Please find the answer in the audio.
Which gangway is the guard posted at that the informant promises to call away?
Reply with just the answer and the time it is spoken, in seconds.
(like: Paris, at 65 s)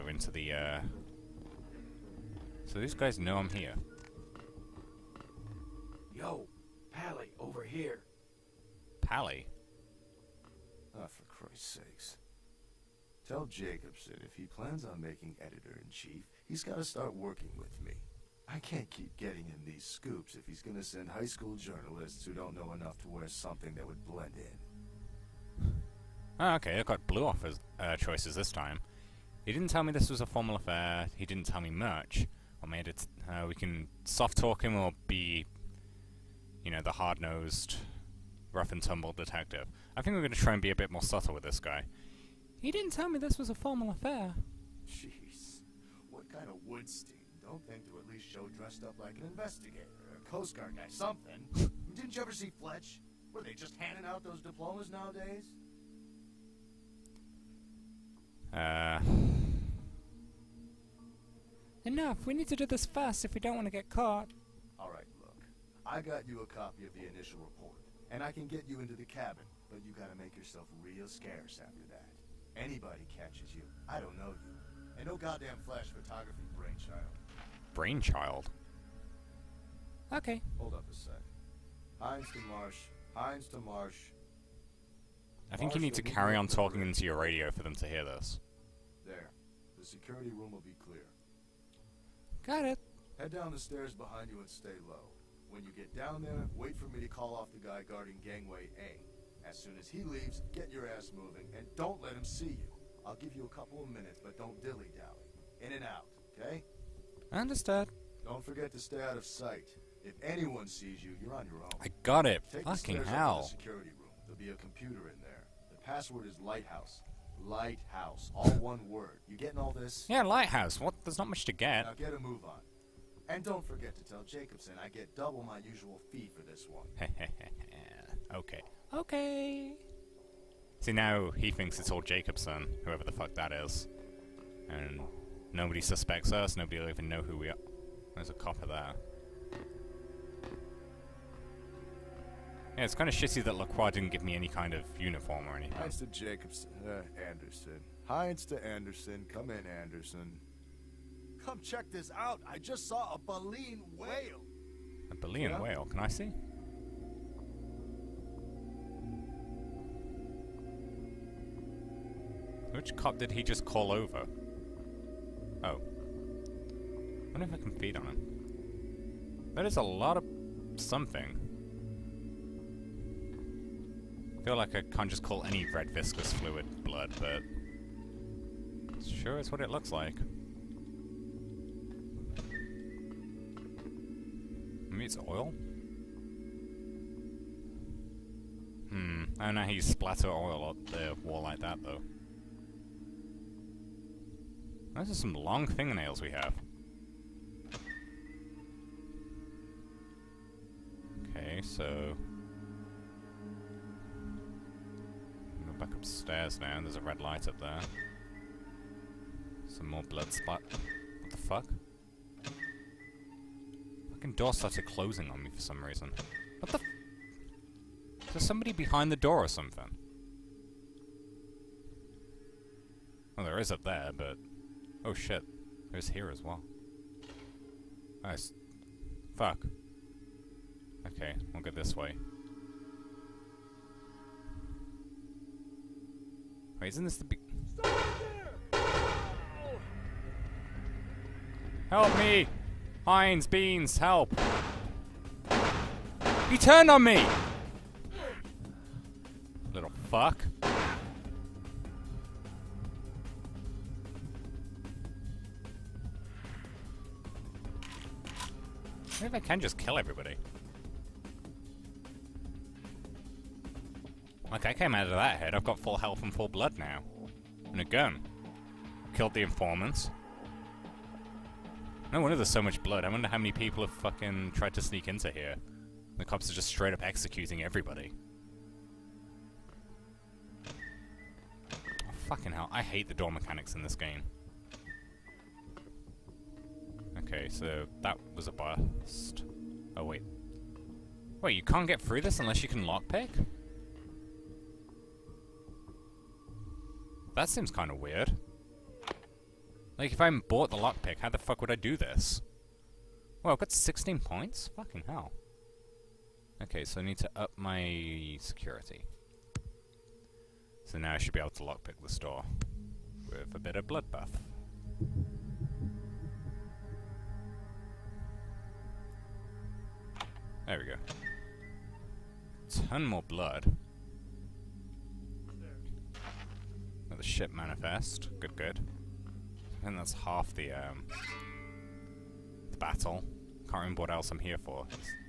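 Gangway A, at 98 s.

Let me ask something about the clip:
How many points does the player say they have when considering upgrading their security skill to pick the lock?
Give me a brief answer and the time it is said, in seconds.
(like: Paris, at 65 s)
16, at 303 s.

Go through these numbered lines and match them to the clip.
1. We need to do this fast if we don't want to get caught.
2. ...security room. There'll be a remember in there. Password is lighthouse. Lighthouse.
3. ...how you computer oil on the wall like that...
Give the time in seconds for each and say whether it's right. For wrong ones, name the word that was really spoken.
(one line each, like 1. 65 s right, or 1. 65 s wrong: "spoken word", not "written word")
1. 62 s right
2. 113 s wrong: "computer", not "remember"
3. 189 s wrong: "splatter", not "computer".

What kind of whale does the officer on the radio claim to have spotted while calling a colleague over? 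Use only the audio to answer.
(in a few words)
Baleen whale.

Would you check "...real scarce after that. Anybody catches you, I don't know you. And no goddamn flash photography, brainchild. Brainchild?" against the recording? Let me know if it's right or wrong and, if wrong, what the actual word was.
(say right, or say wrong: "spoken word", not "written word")
right.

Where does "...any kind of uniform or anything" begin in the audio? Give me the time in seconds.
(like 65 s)
144 s.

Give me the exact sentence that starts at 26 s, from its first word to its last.
Ah, okay, I got blue offers, uh, choices this time.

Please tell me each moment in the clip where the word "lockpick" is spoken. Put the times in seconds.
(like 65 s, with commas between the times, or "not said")
292 s, 300 s, 311 s.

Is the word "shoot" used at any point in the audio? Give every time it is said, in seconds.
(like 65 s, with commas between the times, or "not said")
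not said.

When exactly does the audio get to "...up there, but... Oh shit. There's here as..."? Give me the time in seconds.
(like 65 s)
223 s.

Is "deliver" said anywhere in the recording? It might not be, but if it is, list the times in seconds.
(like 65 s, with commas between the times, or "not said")
not said.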